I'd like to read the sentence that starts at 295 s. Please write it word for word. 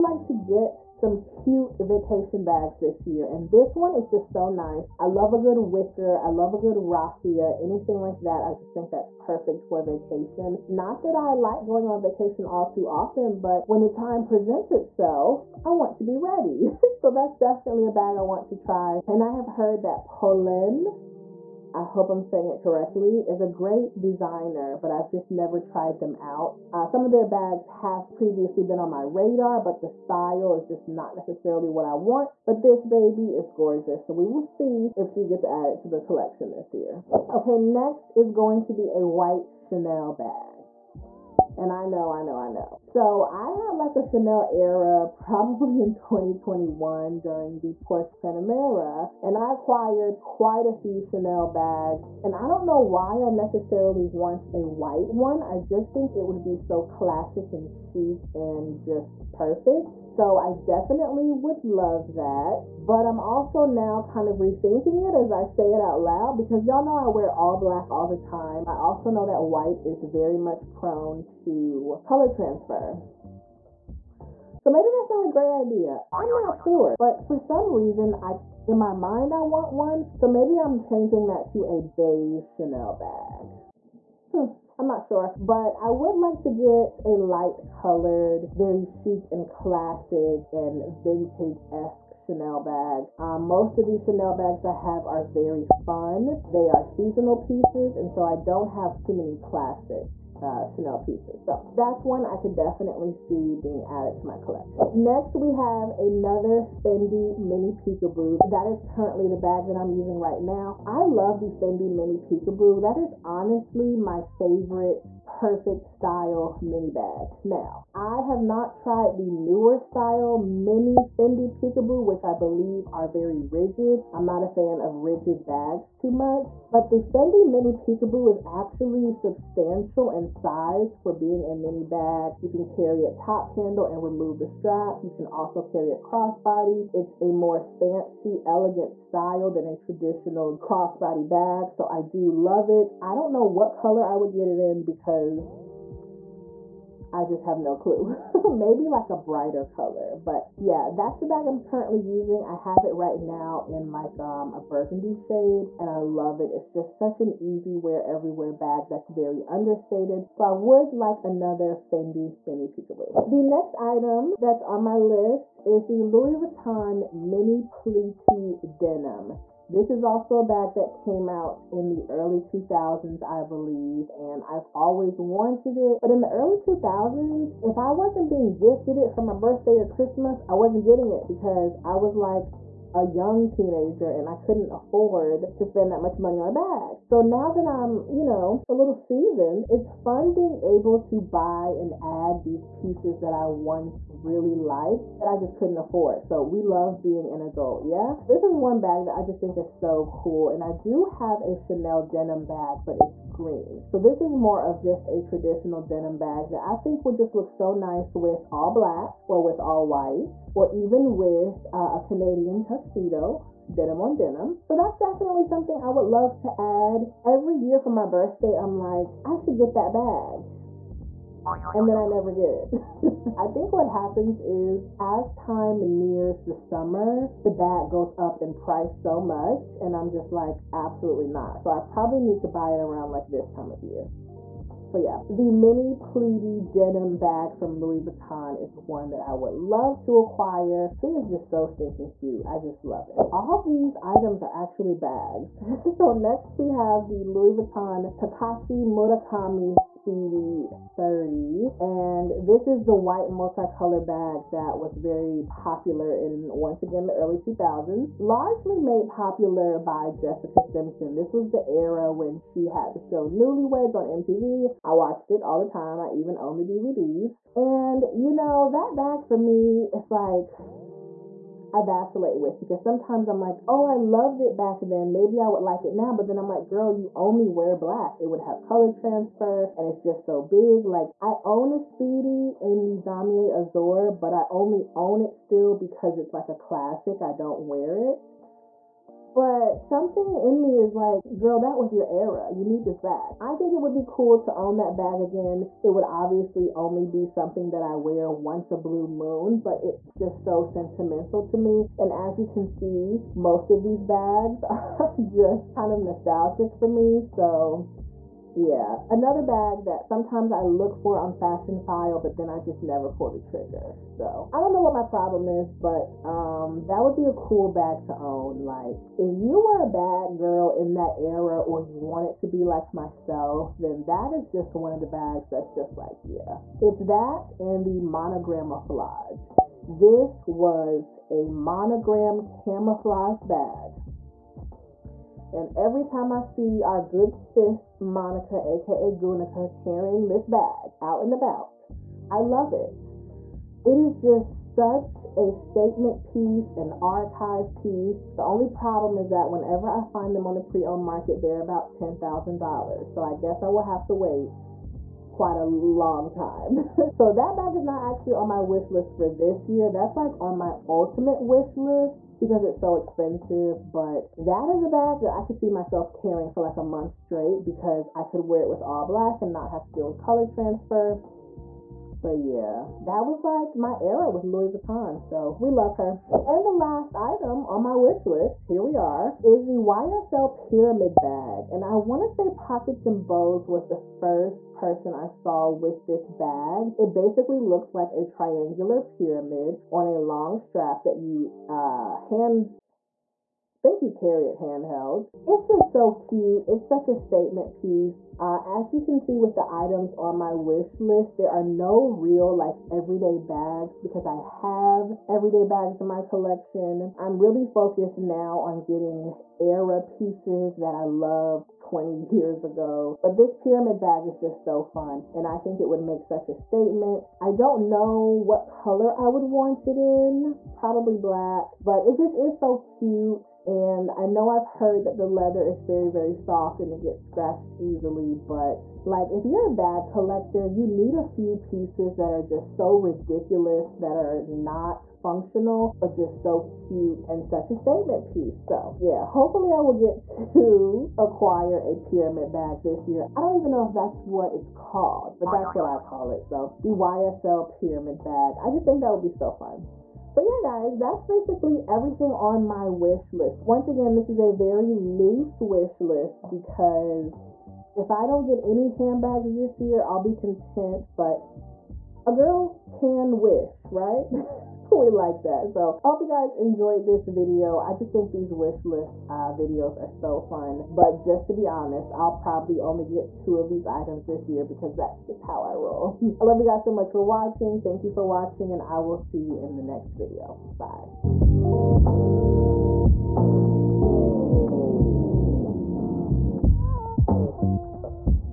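It would obviously only be something that I wear once a blue moon, but it's just so sentimental to me.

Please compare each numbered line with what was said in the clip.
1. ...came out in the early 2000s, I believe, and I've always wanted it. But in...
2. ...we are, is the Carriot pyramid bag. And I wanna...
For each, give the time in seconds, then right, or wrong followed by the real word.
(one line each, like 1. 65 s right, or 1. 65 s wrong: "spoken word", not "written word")
1. 170 s right
2. 378 s wrong: "YSL", not "Carriot".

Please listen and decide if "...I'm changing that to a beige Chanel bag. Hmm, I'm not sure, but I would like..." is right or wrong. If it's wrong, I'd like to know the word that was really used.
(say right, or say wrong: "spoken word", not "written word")
right.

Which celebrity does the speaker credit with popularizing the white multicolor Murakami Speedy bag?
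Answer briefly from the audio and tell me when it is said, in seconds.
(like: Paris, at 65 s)
Jessica Simpson, at 260 s.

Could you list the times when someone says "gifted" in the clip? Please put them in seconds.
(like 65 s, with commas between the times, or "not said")
178 s.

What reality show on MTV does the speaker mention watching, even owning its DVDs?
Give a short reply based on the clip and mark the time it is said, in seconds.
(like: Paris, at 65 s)
Newlyweds, at 263 s.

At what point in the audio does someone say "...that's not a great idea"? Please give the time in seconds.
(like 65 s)
74 s.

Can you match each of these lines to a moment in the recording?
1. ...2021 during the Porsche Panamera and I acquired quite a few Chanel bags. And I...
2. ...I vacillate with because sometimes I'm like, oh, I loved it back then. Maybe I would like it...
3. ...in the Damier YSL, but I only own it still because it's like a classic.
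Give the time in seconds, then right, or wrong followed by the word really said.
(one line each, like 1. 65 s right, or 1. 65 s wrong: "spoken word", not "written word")
1. 45 s right
2. 271 s right
3. 282 s wrong: "Azur", not "YSL".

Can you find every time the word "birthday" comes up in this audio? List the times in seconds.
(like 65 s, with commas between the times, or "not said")
179 s, 218 s.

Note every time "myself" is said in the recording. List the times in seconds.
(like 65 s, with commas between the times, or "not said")
322 s, 365 s.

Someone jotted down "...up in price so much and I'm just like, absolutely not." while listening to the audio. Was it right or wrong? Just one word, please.
right.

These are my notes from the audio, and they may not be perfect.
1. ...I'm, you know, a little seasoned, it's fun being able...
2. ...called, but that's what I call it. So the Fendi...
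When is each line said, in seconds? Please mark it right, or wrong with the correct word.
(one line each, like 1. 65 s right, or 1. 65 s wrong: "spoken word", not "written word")
1. 187 s right
2. 444 s wrong: "YSL", not "Fendi".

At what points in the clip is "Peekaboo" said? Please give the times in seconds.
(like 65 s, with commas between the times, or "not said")
107 s, 112 s, 121 s, 127 s, 162 s.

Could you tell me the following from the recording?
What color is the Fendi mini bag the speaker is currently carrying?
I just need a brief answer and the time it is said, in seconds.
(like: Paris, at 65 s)
Burgundy, at 154 s.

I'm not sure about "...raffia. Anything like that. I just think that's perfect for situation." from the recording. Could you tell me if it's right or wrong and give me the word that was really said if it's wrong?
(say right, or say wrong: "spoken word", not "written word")
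wrong: "vacation", not "situation".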